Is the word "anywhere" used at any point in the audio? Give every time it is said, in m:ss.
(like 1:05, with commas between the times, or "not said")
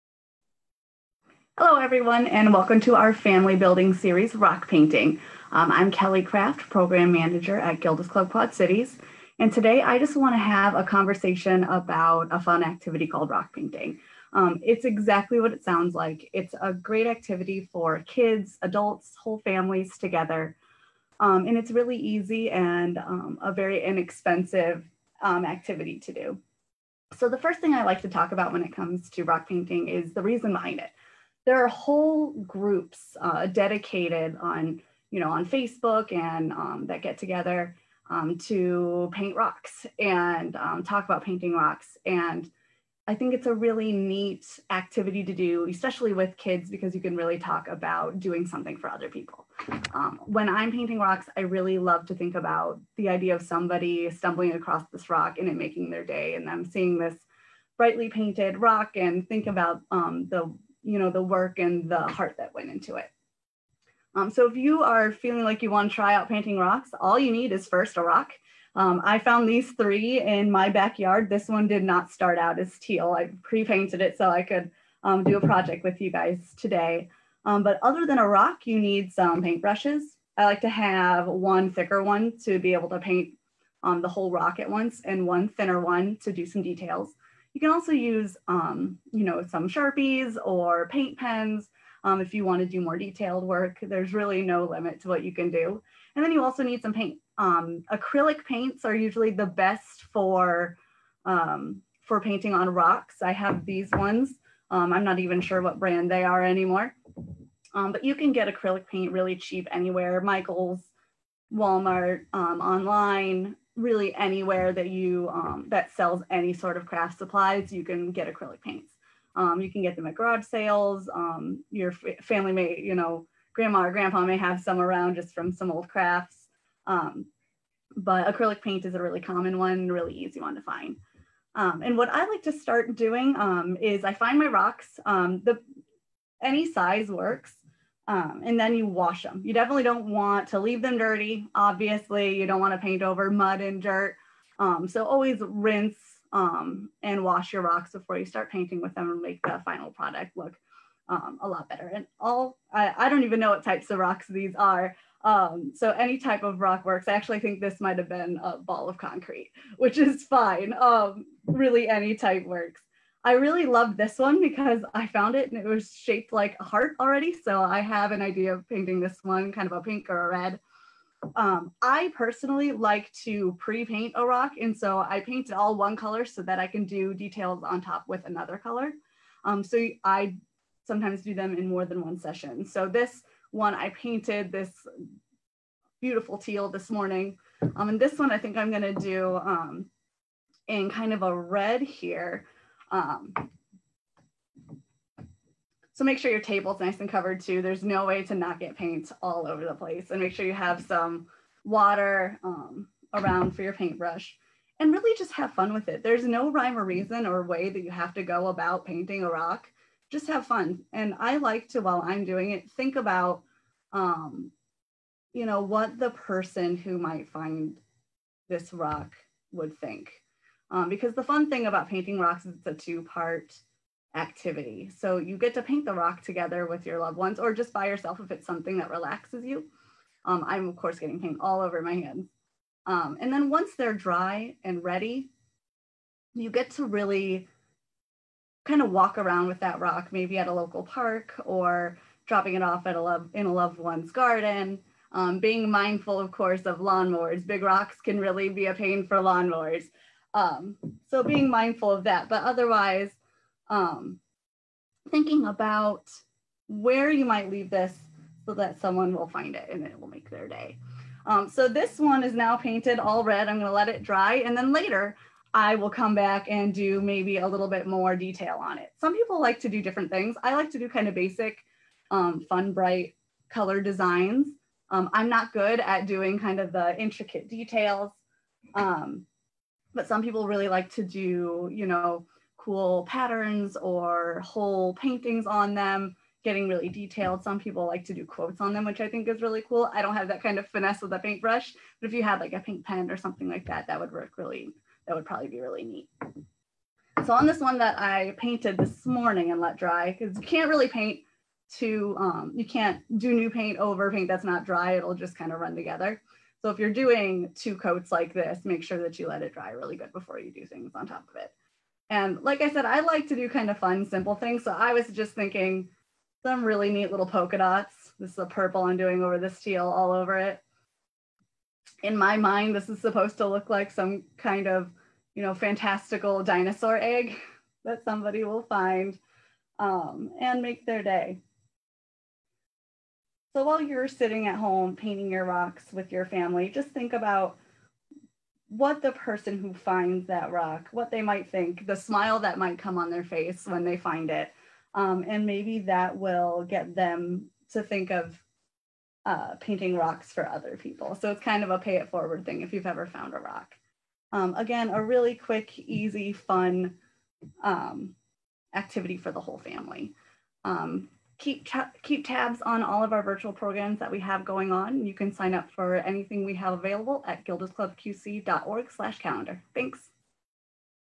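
1:49, 1:54.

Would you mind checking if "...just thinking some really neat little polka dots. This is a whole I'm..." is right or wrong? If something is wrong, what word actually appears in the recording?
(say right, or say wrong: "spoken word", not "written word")
wrong: "purple", not "whole".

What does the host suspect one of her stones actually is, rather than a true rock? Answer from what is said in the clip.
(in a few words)
a ball of concrete.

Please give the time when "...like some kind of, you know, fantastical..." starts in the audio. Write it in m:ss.
5:23.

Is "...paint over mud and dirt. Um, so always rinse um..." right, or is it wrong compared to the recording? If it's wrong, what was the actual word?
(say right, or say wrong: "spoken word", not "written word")
right.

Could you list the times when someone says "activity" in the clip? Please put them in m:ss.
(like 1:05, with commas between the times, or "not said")
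0:12, 0:17, 0:25, 0:44, 3:44, 5:58.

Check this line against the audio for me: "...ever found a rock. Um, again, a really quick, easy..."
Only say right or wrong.
right.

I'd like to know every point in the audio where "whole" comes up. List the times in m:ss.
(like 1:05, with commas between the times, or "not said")
0:19, 0:31, 1:24, 4:44, 5:59.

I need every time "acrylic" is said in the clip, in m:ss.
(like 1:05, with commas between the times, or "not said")
1:37, 1:48, 1:58, 2:08.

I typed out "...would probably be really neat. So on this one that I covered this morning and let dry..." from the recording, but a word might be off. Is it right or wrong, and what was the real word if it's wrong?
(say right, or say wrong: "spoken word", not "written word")
wrong: "painted", not "covered".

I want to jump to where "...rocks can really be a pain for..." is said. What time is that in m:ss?
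4:07.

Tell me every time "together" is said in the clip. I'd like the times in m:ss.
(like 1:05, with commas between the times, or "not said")
0:19, 0:37, 3:46, 5:05.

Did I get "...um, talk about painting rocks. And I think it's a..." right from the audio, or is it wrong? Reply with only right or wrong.
right.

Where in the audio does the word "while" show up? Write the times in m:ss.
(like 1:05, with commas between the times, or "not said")
3:31, 5:33.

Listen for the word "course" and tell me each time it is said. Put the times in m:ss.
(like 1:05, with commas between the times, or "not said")
3:50, 4:06.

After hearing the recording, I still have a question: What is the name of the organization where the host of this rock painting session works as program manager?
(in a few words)
Gilda's Club Quad Cities.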